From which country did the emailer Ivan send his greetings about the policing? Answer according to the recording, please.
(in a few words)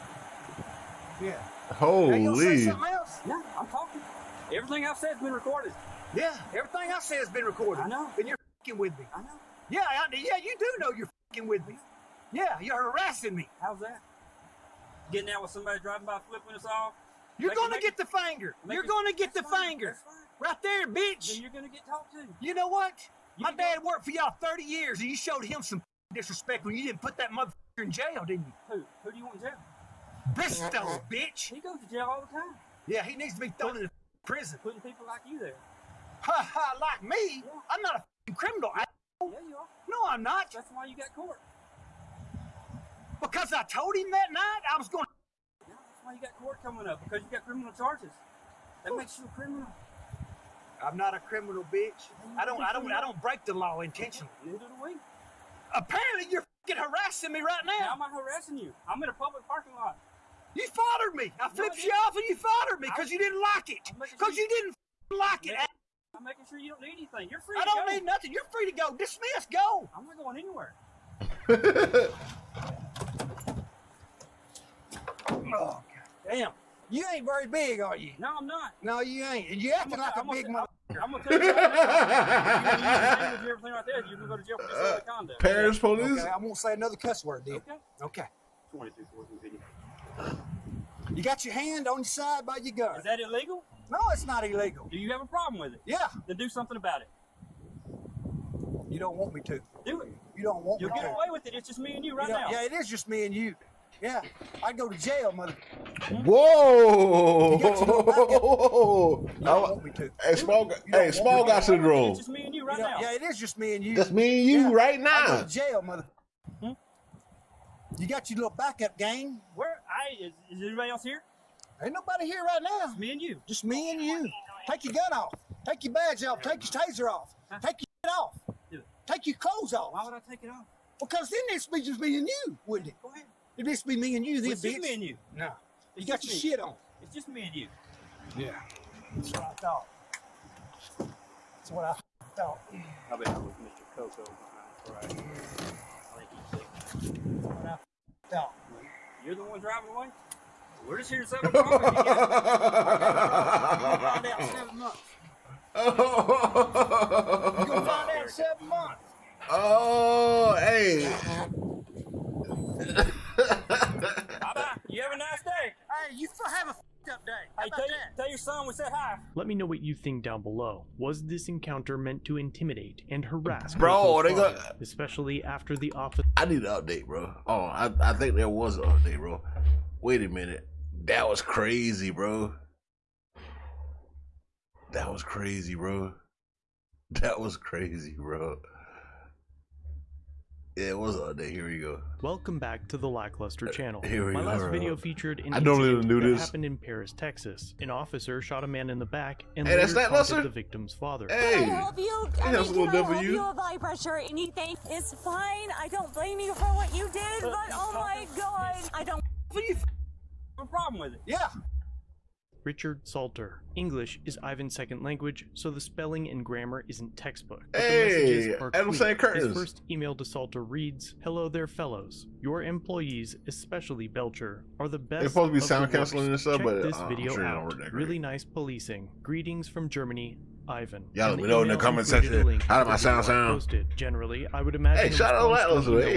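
Germany.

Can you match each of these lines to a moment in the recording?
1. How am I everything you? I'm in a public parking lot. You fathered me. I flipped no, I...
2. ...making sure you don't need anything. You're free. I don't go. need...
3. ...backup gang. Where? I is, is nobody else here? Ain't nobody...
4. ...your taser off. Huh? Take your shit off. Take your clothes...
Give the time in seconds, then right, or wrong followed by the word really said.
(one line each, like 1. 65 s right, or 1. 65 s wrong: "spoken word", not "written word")
1. 57 s wrong: "harassing", not "everything"
2. 66 s right
3. 118 s wrong: "anybody", not "nobody"
4. 126 s right.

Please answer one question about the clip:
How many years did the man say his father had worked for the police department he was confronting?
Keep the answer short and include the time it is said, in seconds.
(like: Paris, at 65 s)
30, at 24 s.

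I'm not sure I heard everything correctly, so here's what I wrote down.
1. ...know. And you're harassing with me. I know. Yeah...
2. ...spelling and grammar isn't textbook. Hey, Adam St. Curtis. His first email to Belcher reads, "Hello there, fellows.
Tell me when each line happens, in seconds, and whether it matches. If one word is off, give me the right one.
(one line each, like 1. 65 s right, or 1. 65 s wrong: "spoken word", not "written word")
1. 7 s wrong: "fucking", not "harassing"
2. 215 s wrong: "Salter", not "Belcher".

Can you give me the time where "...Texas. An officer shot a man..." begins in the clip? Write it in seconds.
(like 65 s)
197 s.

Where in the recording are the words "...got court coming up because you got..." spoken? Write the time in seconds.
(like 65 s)
46 s.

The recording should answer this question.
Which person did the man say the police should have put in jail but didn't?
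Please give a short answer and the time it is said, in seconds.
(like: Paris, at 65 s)
Bristow, at 30 s.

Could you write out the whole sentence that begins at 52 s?
I don't break the law intentionally.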